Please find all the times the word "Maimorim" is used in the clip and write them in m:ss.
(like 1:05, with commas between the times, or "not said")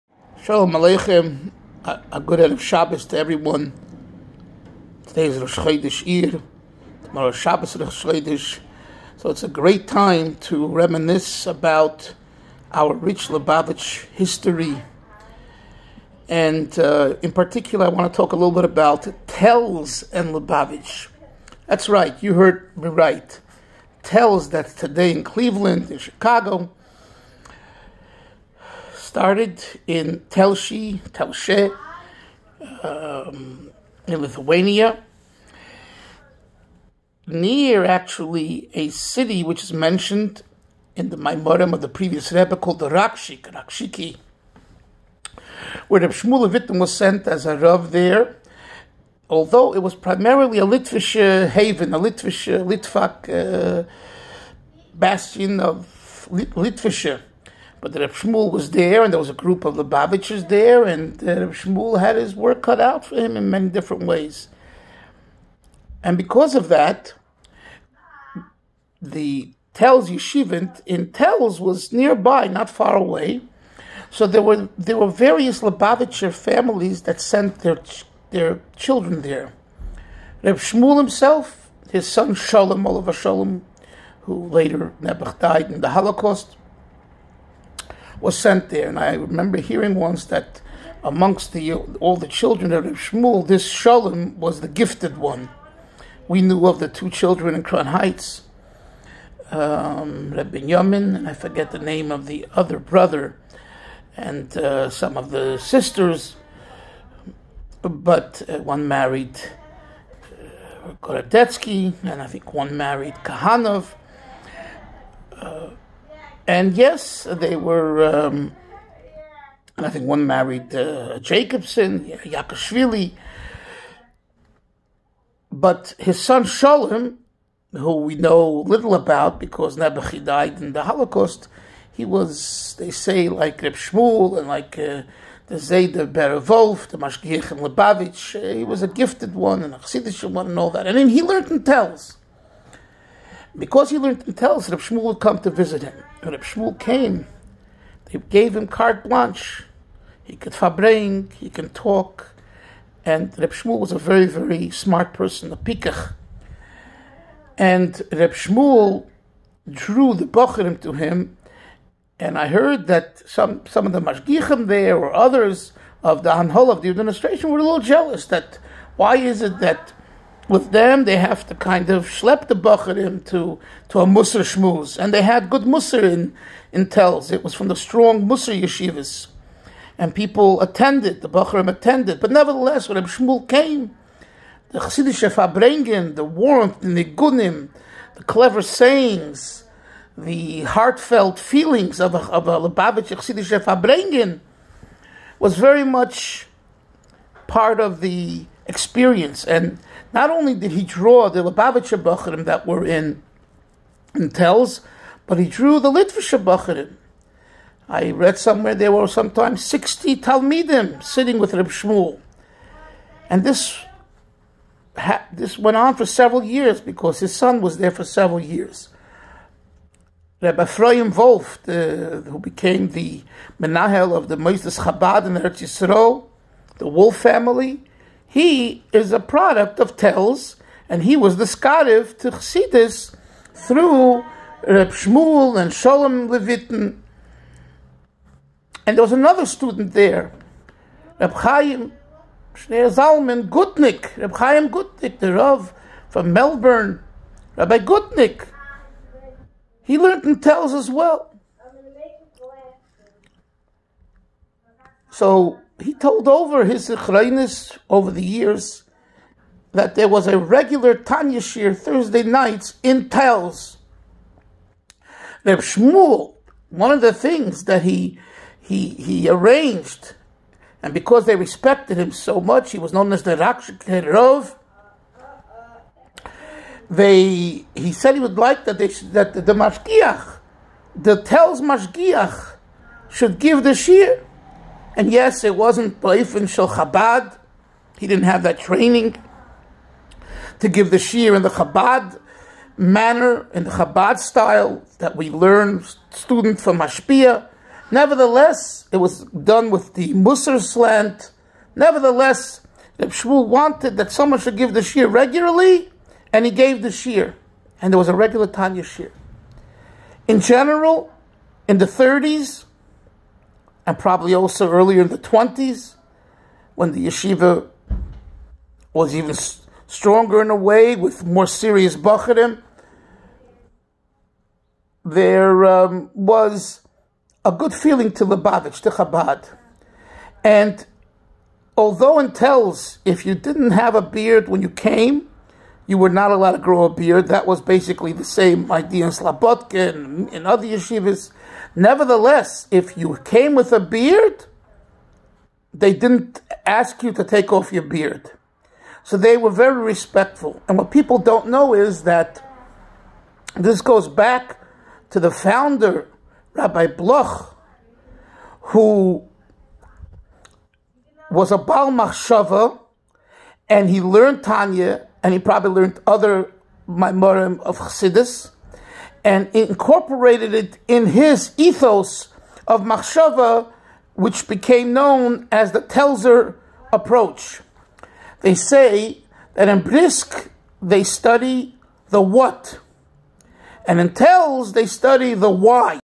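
0:41, 6:06.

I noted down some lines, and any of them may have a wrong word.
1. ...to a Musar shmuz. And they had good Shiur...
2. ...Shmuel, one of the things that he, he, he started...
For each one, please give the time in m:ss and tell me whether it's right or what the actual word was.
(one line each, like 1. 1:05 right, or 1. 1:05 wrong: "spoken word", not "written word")
1. 2:53 wrong: "Musar", not "Shiur"
2. 4:25 wrong: "arranged", not "started".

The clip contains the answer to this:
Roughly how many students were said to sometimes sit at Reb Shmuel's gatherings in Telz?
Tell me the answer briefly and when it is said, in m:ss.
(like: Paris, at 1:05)
60, at 3:29.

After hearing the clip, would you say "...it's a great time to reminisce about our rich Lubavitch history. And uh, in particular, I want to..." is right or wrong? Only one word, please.
right.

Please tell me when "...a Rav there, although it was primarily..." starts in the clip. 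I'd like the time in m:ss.
0:47.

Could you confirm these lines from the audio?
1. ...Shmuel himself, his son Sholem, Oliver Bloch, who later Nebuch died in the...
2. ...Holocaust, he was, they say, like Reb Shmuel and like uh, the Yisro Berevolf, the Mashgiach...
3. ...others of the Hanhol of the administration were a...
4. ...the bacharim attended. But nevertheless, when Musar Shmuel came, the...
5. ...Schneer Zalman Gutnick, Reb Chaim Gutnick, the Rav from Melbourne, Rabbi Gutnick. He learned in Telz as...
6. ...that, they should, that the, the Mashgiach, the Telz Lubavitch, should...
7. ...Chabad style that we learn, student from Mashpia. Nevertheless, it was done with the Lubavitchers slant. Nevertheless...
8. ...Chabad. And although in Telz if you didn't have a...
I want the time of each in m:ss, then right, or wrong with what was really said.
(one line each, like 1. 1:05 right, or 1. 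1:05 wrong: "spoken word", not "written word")
1. 1:20 wrong: "Sholem", not "Bloch"
2. 2:10 wrong: "Zayda", not "Yisro"
3. 2:45 right
4. 3:01 wrong: "Reb", not "Musar"
5. 4:02 right
6. 4:38 wrong: "Mashgiach", not "Lubavitch"
7. 4:53 wrong: "Musar", not "Lubavitchers"
8. 5:28 right.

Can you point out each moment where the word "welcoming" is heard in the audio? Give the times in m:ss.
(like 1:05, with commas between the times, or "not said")
not said.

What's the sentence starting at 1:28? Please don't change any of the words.
And I remember hearing once that amongst the, all the children of Shmuel, this Shalom was the gifted one.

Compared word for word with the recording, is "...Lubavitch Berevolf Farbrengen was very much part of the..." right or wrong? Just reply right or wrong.
wrong.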